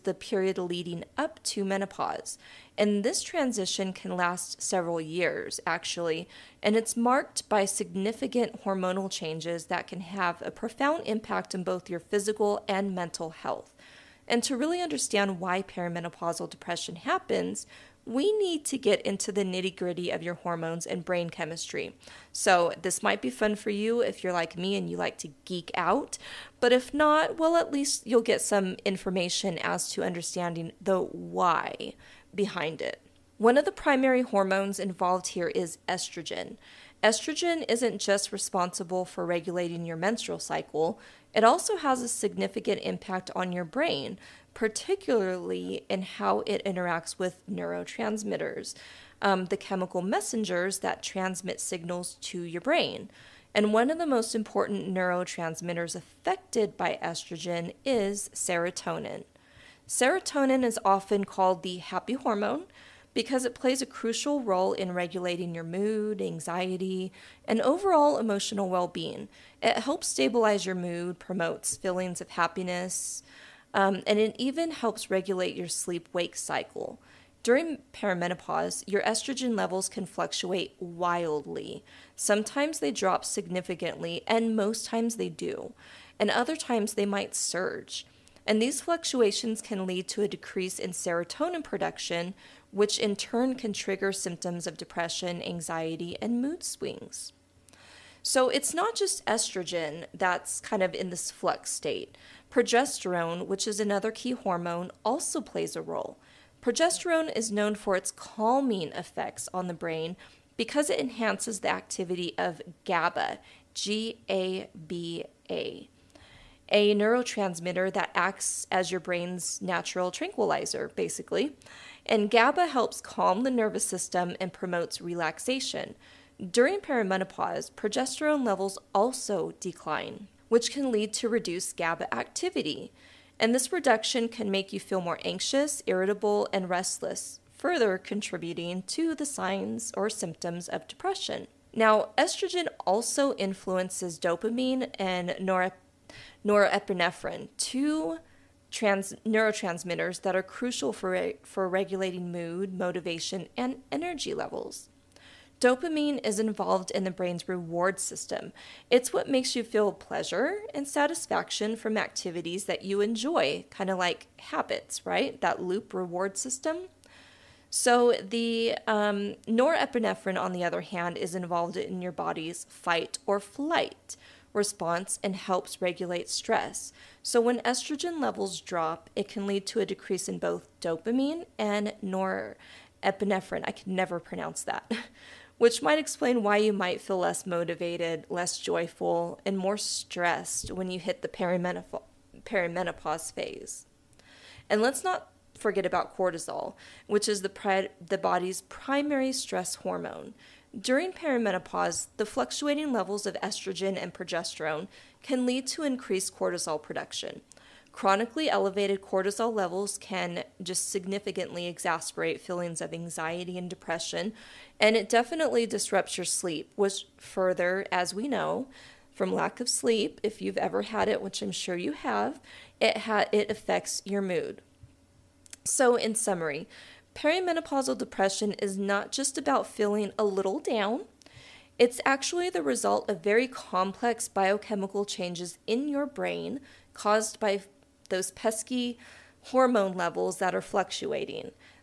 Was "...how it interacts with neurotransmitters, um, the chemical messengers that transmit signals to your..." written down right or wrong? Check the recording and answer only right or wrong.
right.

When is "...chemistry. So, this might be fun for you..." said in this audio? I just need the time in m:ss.
0:21.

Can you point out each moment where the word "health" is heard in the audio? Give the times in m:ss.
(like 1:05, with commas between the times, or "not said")
0:13.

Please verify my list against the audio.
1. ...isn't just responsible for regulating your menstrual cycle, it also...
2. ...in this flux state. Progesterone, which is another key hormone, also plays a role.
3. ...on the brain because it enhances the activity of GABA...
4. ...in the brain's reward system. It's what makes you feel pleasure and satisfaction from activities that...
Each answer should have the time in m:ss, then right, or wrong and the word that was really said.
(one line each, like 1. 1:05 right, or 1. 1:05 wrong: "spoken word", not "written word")
1. 0:37 right
2. 1:40 right
3. 1:49 right
4. 2:36 right.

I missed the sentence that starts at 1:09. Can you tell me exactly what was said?
It helps stabilize your mood, promotes feelings of happiness, um, and it even helps regulate your sleep wake cycle.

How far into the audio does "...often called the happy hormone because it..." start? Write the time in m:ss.
1:00.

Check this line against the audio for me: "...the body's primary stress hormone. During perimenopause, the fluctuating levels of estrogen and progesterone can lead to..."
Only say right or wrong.
right.